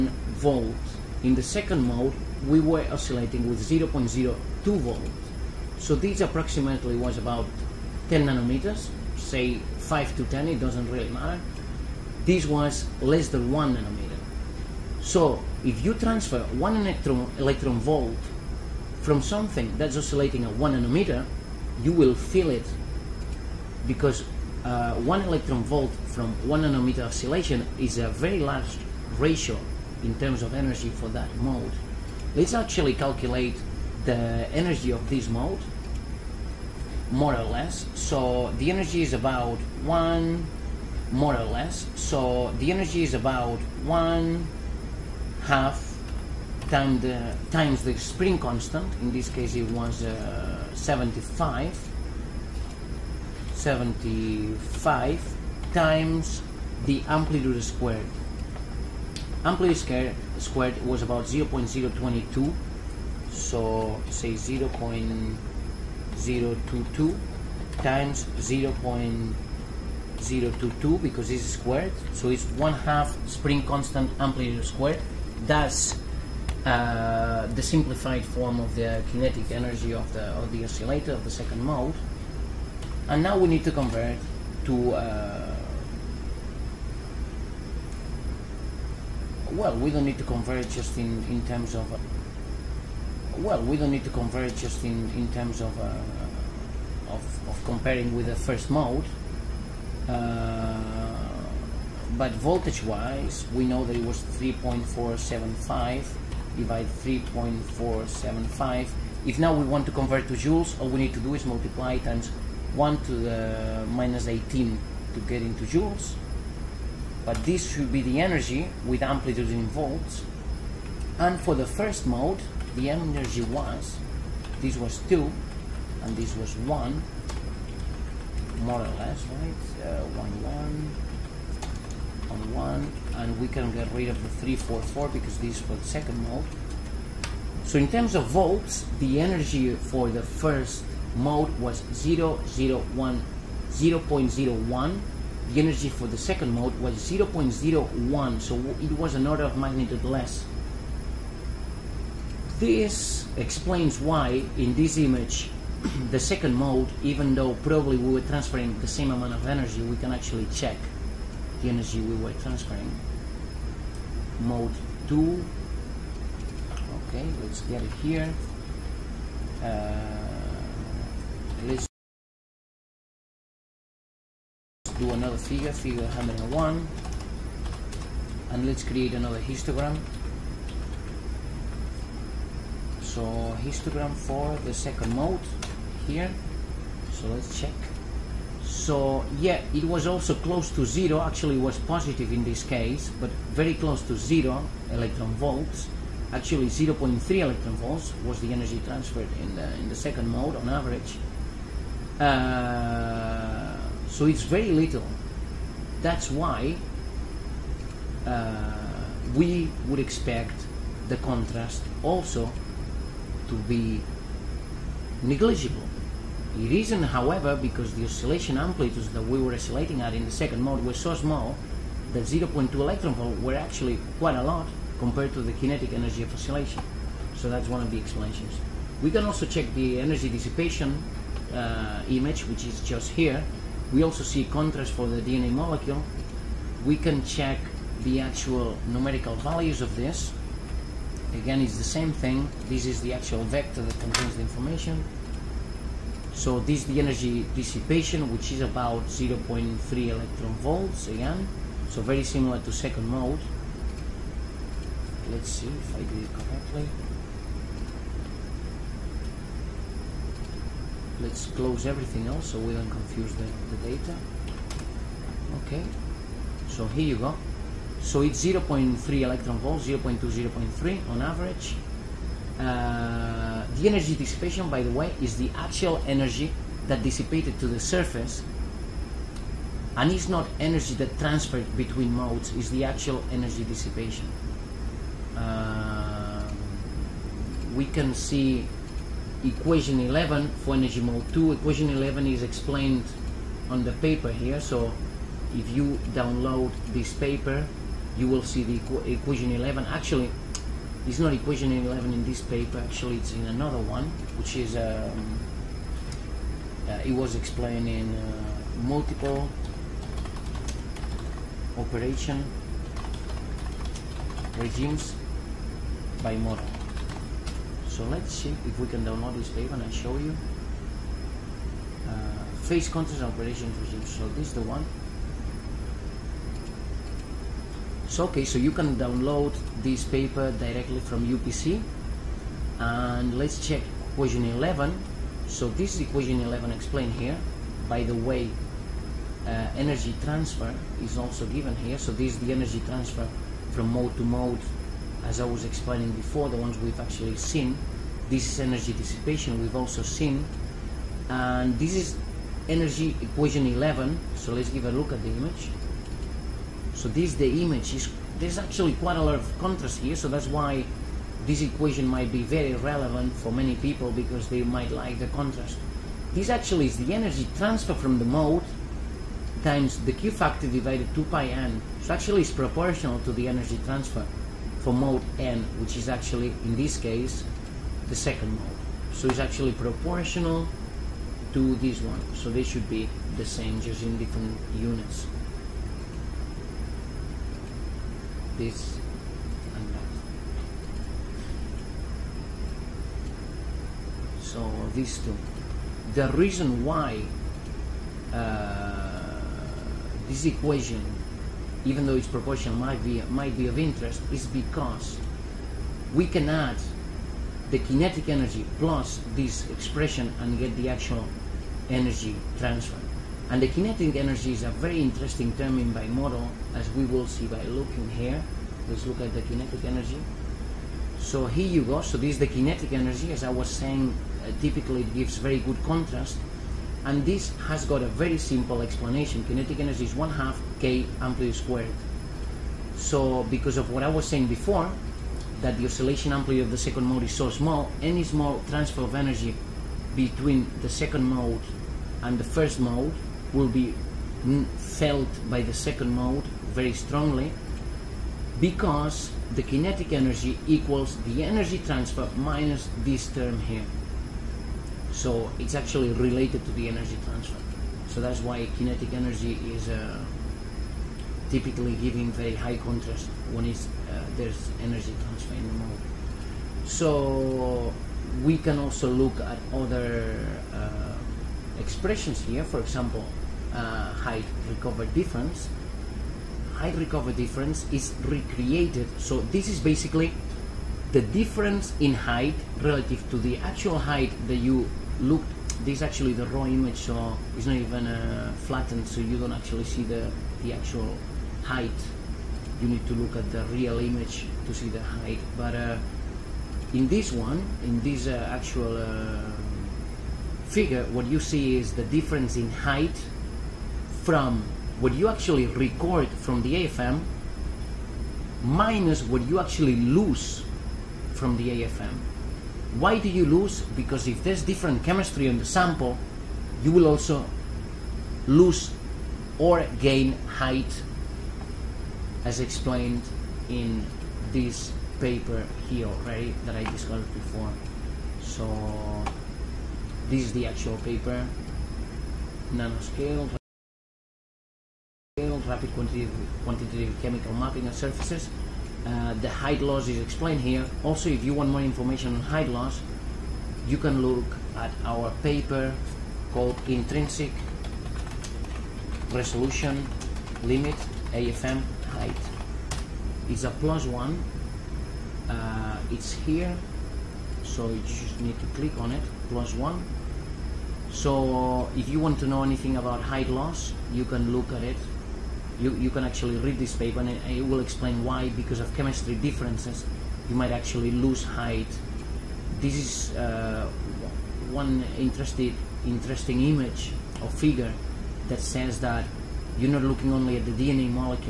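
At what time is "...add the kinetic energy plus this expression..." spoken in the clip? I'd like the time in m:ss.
6:46.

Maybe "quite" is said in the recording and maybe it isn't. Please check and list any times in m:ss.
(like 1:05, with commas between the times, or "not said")
3:44, 5:58.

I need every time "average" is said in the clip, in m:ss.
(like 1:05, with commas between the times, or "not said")
3:20, 4:31.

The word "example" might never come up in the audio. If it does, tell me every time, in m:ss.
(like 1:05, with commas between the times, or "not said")
7:52.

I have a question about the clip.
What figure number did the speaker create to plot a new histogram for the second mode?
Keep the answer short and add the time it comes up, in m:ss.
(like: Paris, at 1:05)
101, at 2:55.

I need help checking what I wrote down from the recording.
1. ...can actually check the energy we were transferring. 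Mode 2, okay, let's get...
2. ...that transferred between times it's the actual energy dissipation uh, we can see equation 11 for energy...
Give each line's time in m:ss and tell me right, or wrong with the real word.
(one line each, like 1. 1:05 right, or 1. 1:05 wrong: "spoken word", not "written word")
1. 2:39 right
2. 4:40 wrong: "modes", not "times".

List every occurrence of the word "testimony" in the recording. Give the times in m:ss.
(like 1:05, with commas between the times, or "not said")
not said.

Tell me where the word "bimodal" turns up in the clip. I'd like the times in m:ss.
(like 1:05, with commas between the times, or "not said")
5:16, 6:55.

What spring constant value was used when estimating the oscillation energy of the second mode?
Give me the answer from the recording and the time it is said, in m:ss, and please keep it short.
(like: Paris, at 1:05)
75, at 0:50.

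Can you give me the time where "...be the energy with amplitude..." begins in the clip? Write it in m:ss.
1:57.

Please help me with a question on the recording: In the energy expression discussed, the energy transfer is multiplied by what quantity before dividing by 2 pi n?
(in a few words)
Q factor.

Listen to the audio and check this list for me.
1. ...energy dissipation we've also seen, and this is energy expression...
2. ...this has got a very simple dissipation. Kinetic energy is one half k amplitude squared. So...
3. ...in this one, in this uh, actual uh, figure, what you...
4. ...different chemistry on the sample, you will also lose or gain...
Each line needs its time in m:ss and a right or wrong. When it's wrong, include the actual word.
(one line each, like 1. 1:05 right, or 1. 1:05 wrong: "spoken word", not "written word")
1. 5:48 wrong: "equation", not "expression"
2. 7:07 wrong: "explanation", not "dissipation"
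3. 8:16 right
4. 8:34 right.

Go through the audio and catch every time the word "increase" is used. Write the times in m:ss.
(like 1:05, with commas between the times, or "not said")
not said.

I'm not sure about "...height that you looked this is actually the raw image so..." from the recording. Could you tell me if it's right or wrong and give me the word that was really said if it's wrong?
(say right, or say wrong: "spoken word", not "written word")
right.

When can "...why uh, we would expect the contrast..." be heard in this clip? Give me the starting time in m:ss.
3:26.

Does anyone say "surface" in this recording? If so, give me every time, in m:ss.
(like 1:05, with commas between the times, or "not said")
4:37, 8:57.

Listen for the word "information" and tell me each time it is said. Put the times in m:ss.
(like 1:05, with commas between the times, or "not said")
4:04, 9:01.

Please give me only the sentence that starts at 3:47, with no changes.
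So that's one of the explanations.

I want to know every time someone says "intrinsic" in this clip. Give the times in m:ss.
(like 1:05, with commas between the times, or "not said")
9:06.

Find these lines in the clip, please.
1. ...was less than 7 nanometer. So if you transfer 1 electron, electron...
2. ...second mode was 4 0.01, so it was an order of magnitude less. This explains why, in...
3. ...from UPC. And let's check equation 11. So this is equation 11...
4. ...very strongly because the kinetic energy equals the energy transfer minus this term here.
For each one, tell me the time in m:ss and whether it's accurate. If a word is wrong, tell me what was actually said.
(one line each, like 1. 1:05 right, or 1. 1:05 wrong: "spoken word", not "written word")
1. 0:12 wrong: "1", not "7"
2. 2:26 wrong: "0", not "4"
3. 5:31 right
4. 7:26 right.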